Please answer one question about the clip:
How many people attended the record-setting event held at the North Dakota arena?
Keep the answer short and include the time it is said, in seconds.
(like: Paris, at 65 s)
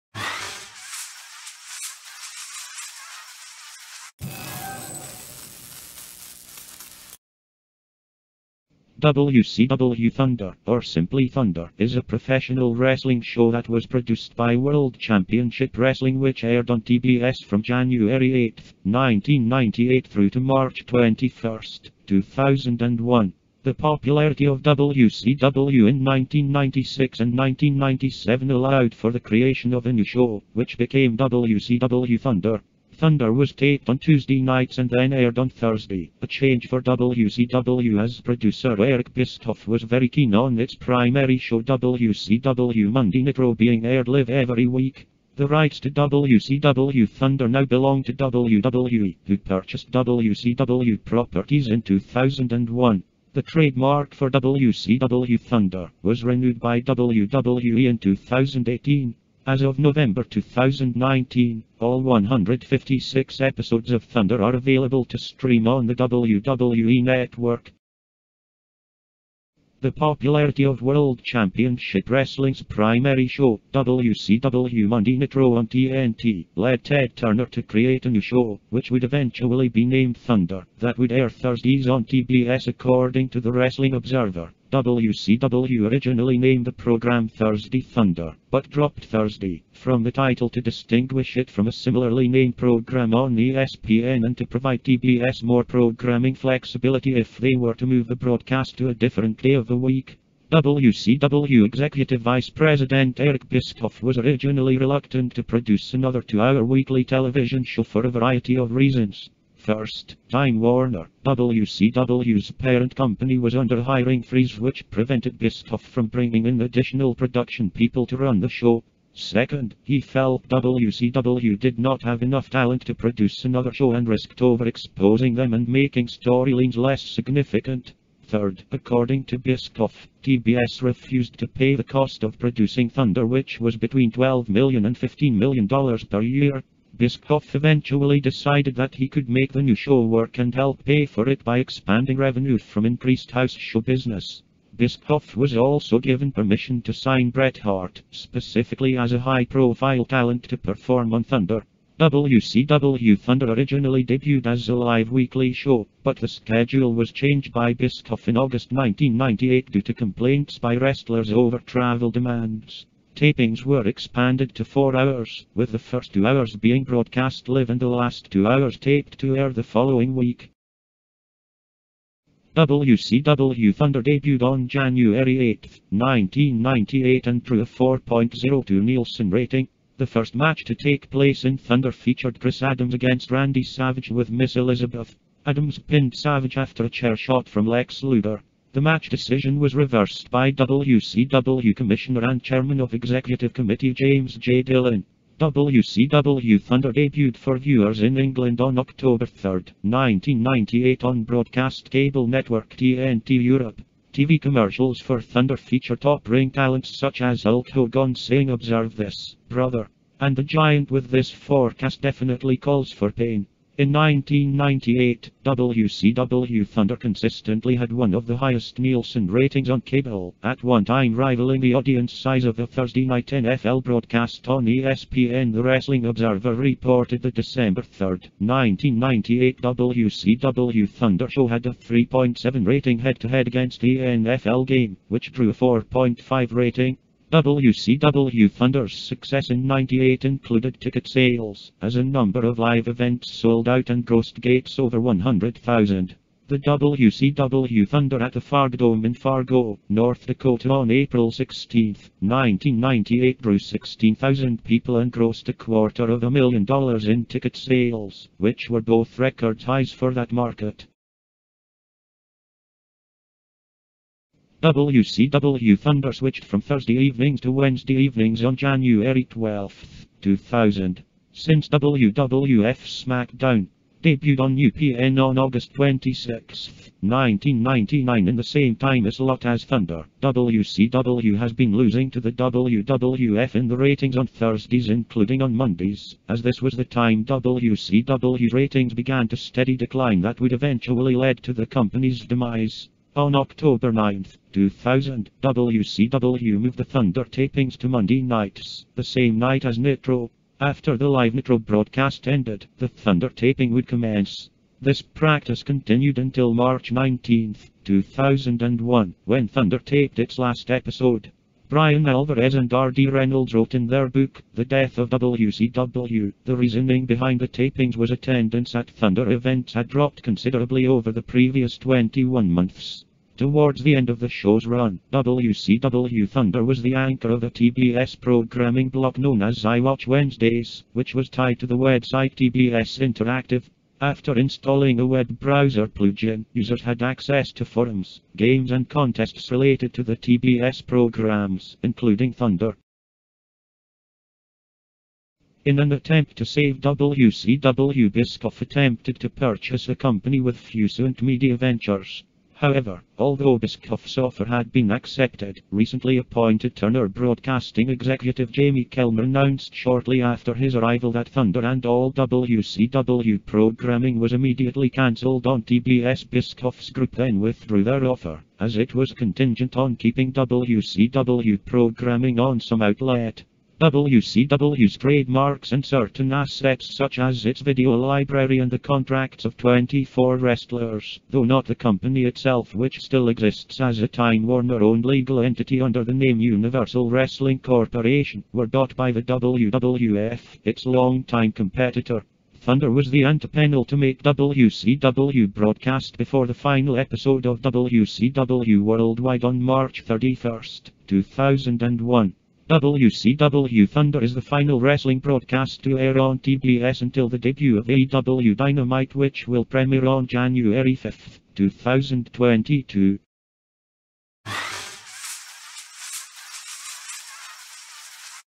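16,000, at 253 s.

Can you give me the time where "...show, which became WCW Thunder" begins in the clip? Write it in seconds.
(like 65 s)
30 s.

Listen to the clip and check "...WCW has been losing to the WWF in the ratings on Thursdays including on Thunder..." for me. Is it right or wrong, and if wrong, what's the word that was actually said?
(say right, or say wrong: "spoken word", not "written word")
wrong: "Mondays", not "Thunder".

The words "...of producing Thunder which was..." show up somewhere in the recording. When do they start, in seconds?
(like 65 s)
132 s.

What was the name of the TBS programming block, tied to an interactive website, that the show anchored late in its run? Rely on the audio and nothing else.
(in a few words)
I Watch Wednesdays.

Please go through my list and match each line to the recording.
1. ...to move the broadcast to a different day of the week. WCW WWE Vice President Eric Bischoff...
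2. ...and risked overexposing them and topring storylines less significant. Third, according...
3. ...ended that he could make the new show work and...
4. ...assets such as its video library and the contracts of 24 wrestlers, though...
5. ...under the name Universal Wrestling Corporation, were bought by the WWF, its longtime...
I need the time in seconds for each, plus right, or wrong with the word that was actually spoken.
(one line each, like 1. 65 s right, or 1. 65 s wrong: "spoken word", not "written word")
1. 97 s wrong: "Executive", not "WWE"
2. 123 s wrong: "making", not "topring"
3. 138 s wrong: "decided", not "ended"
4. 376 s right
5. 385 s right.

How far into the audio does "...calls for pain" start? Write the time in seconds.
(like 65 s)
212 s.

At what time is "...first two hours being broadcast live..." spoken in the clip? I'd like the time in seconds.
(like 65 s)
165 s.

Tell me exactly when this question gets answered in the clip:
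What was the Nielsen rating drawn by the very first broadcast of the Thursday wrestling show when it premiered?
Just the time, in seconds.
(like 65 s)
177 s.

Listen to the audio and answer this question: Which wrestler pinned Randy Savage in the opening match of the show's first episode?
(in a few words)
Chris Adams.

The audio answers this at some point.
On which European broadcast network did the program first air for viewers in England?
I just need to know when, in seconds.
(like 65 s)
202 s.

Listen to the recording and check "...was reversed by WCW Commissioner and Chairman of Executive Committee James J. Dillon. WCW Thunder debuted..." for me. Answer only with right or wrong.
right.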